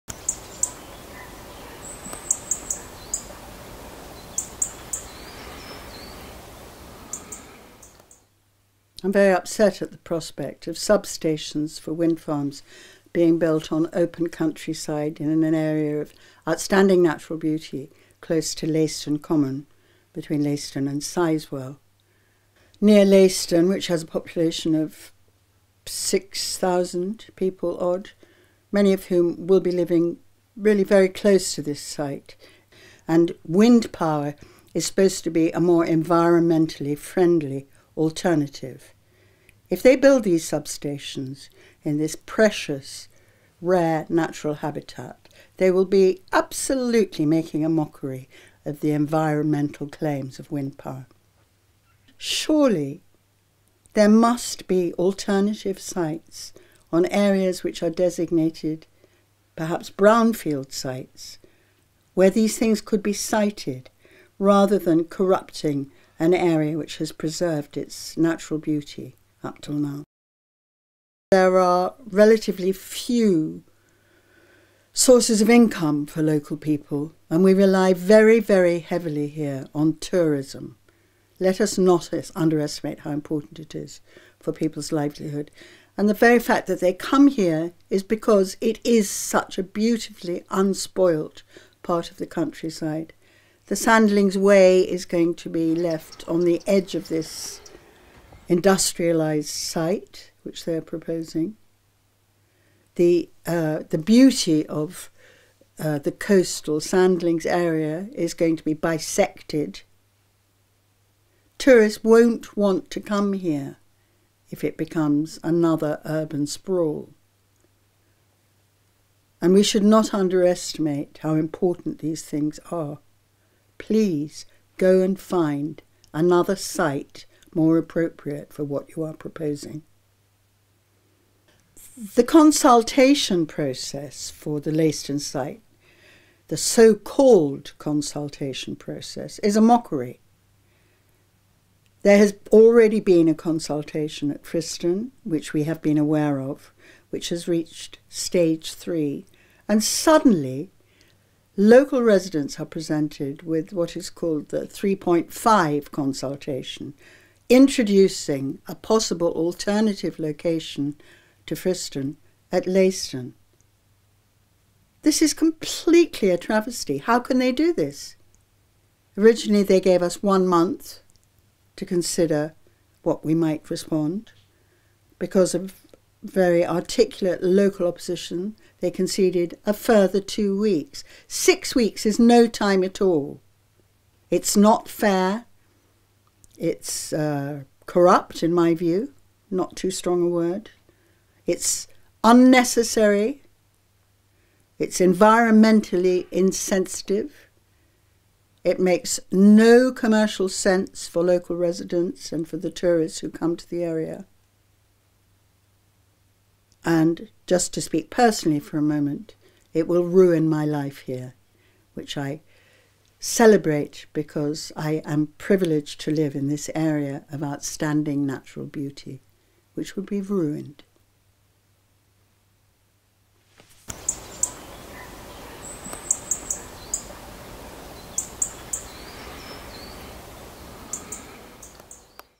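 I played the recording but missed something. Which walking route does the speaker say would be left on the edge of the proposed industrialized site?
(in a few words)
Sandlings Way.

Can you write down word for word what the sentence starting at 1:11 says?
There are relatively few sources of income for local people, and we rely very, very heavily here on tourism.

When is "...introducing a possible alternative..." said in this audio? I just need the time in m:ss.
2:37.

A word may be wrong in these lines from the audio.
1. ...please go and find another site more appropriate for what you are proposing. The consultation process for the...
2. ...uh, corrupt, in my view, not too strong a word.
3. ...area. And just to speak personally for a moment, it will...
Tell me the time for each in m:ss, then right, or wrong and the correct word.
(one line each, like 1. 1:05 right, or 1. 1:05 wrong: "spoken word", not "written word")
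1. 2:03 right
2. 3:07 right
3. 3:23 right.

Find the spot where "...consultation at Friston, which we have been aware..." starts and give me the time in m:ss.
2:23.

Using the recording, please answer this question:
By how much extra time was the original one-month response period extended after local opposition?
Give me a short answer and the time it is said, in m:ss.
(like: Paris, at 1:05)
2 weeks, at 3:00.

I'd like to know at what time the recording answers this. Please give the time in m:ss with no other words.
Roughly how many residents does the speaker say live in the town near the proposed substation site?
0:25.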